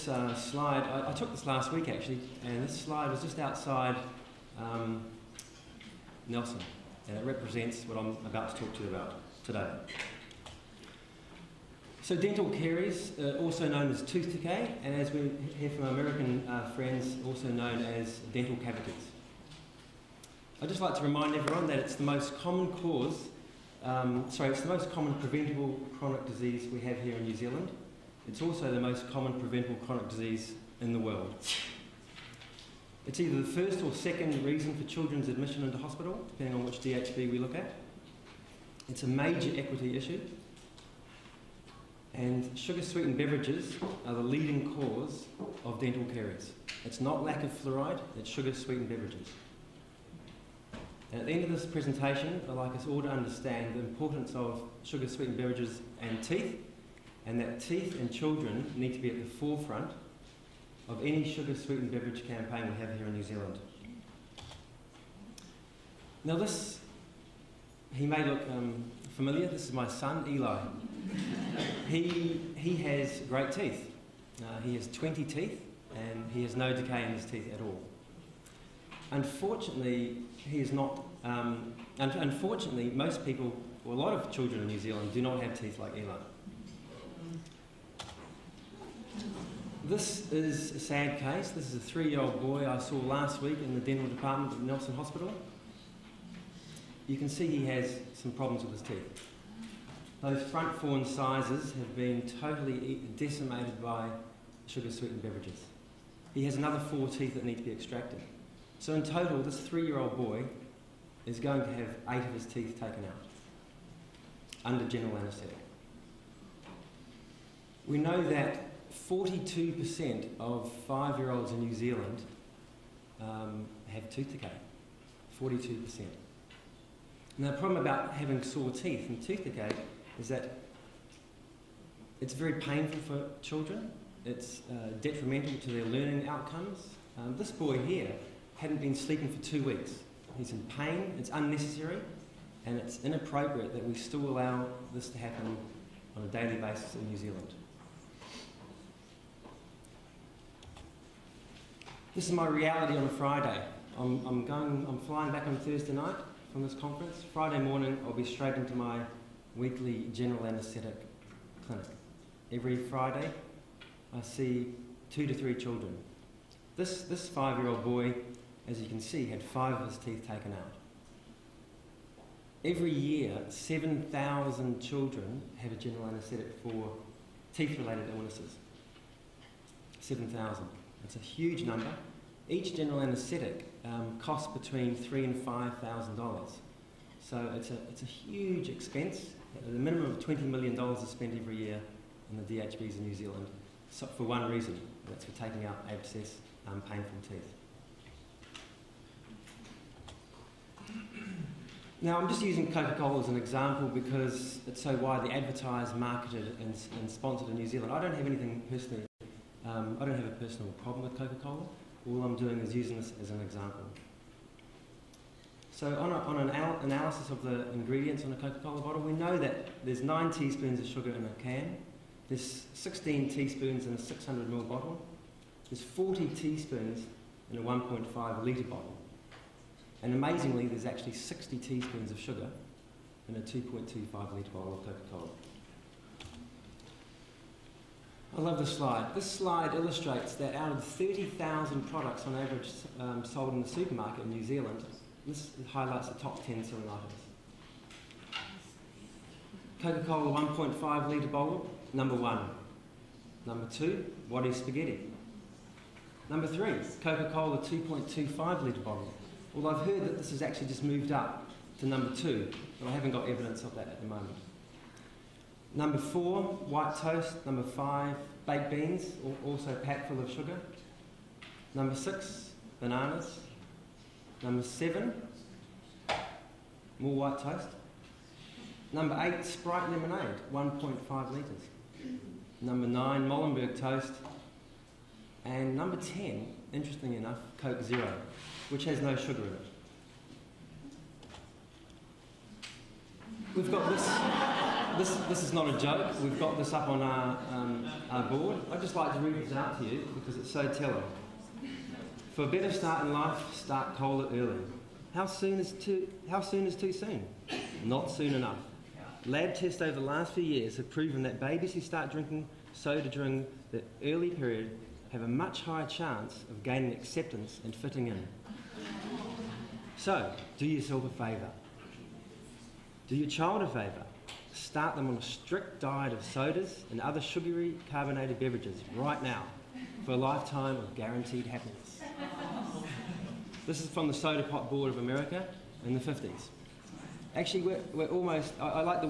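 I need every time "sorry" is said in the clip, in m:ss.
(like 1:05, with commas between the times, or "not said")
0:24.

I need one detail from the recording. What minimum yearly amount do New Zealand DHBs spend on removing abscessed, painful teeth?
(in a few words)
$20 million.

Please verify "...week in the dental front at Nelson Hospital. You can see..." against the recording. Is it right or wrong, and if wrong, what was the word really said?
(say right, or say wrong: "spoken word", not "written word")
wrong: "department", not "front".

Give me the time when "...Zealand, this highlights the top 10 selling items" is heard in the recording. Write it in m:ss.
4:04.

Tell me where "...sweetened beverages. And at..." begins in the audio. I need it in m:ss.
0:48.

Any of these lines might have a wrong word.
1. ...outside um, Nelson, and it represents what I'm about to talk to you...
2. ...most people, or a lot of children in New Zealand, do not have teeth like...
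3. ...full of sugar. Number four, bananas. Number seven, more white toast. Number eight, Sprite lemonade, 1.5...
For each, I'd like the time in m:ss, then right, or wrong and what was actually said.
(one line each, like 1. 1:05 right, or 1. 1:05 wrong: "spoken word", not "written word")
1. 0:03 right
2. 1:22 right
3. 4:30 wrong: "six", not "four".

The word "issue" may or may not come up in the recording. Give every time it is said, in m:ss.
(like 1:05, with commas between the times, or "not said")
0:39.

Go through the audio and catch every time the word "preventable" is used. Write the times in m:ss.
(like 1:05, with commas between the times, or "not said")
0:25, 0:29.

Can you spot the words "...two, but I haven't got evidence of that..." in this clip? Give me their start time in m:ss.
4:22.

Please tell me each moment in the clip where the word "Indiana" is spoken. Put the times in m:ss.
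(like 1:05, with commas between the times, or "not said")
not said.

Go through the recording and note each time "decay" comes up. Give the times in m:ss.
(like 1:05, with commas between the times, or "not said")
0:14, 1:16, 2:04, 2:09.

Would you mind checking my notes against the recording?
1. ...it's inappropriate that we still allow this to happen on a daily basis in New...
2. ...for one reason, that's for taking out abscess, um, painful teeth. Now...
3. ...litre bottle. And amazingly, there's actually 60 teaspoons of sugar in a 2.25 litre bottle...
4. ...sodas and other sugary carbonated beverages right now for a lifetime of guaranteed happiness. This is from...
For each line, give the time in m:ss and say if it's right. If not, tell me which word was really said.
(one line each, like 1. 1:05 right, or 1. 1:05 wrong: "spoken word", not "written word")
1. 2:22 right
2. 3:14 right
3. 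3:48 right
4. 5:26 right.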